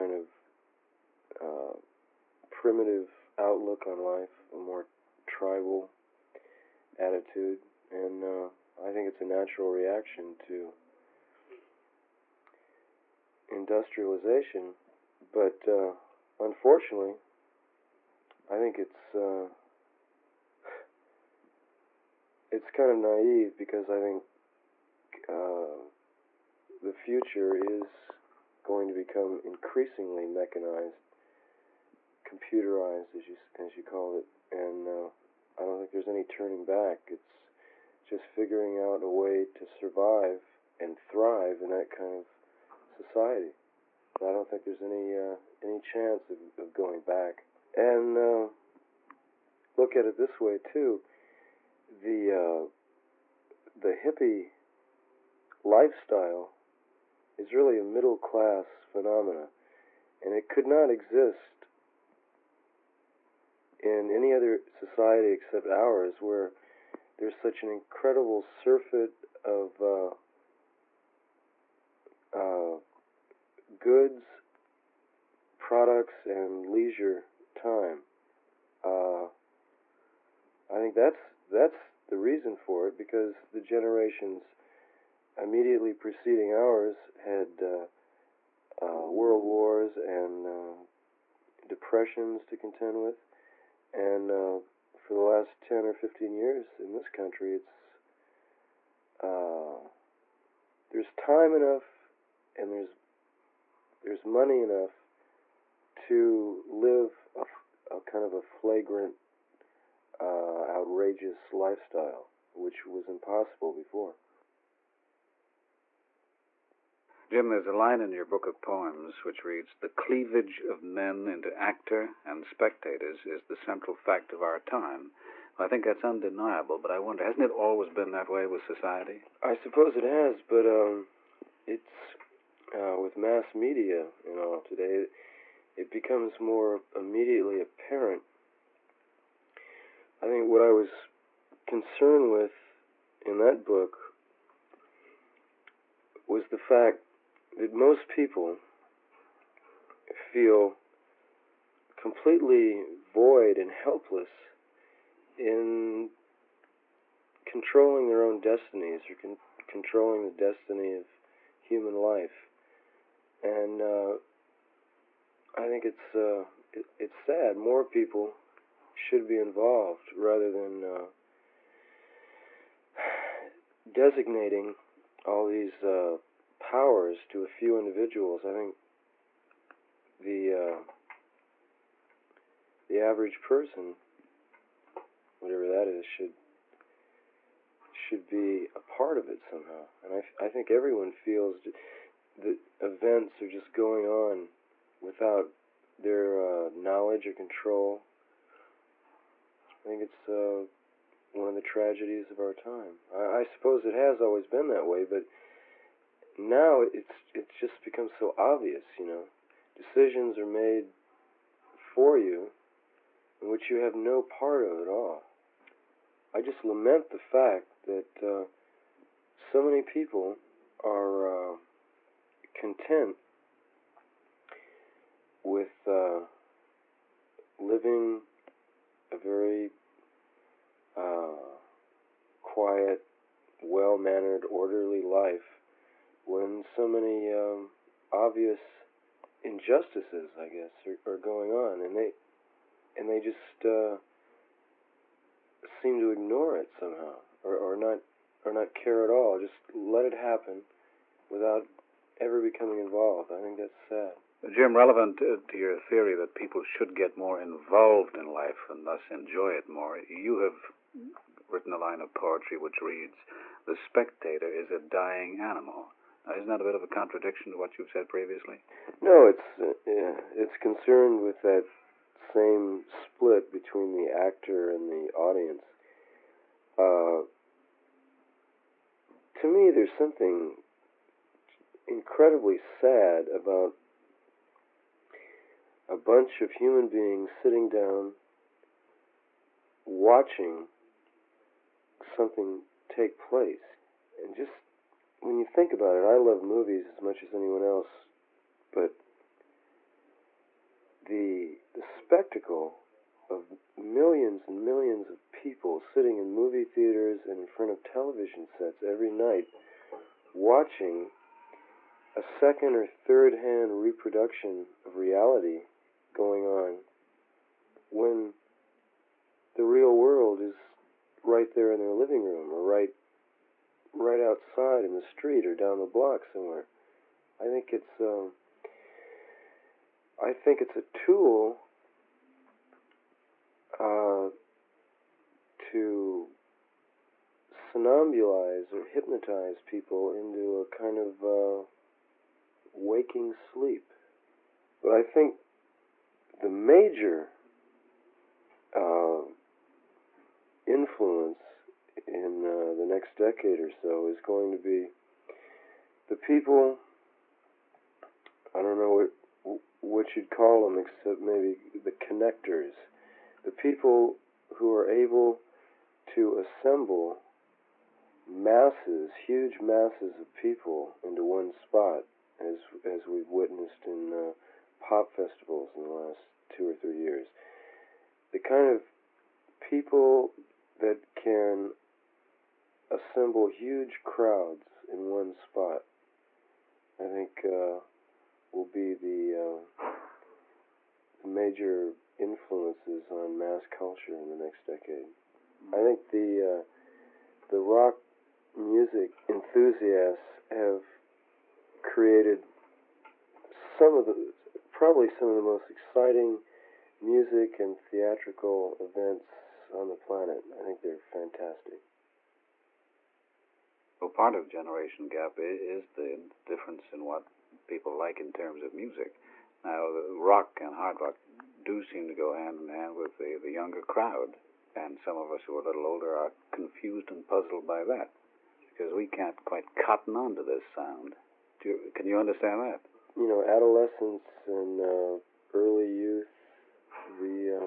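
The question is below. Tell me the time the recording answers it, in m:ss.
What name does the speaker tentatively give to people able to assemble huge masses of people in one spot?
6:01.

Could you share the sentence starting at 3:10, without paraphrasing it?
And I, I think everyone feels that events are just going on without their uh, knowledge or control.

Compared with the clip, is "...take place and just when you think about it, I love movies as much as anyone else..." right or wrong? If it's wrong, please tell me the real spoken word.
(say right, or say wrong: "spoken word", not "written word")
right.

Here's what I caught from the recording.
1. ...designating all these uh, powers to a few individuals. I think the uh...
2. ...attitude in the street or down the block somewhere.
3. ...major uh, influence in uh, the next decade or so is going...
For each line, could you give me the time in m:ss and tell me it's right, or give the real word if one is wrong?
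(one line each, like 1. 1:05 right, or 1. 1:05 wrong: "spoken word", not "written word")
1. 2:53 right
2. 5:24 wrong: "outside", not "attitude"
3. 5:46 right.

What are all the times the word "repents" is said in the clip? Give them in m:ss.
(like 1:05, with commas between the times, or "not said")
not said.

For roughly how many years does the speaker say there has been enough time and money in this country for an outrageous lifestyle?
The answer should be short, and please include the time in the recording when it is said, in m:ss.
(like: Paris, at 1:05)
10 or 15 years, at 1:35.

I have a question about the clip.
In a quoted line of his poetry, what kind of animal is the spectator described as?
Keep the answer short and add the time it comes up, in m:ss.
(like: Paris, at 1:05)
a dying animal, at 4:24.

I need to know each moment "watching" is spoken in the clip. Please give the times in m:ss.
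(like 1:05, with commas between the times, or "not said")
4:49, 5:10.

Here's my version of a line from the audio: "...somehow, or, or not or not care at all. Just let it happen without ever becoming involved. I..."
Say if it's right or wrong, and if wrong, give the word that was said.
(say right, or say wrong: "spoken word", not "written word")
right.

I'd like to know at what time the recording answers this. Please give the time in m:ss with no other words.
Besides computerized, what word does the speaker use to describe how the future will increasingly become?
0:30.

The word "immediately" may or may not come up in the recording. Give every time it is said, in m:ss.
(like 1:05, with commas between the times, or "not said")
1:25, 2:16.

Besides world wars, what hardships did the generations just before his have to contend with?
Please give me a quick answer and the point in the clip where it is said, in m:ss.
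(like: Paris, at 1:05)
depressions, at 1:31.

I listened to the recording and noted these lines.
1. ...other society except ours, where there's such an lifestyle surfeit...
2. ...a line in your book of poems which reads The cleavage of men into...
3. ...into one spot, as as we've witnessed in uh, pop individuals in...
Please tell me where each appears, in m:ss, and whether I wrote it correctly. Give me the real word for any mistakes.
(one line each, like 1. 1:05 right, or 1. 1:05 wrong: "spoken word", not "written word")
1. 1:04 wrong: "incredible", not "lifestyle"
2. 1:57 right
3. 6:11 wrong: "festivals", not "individuals".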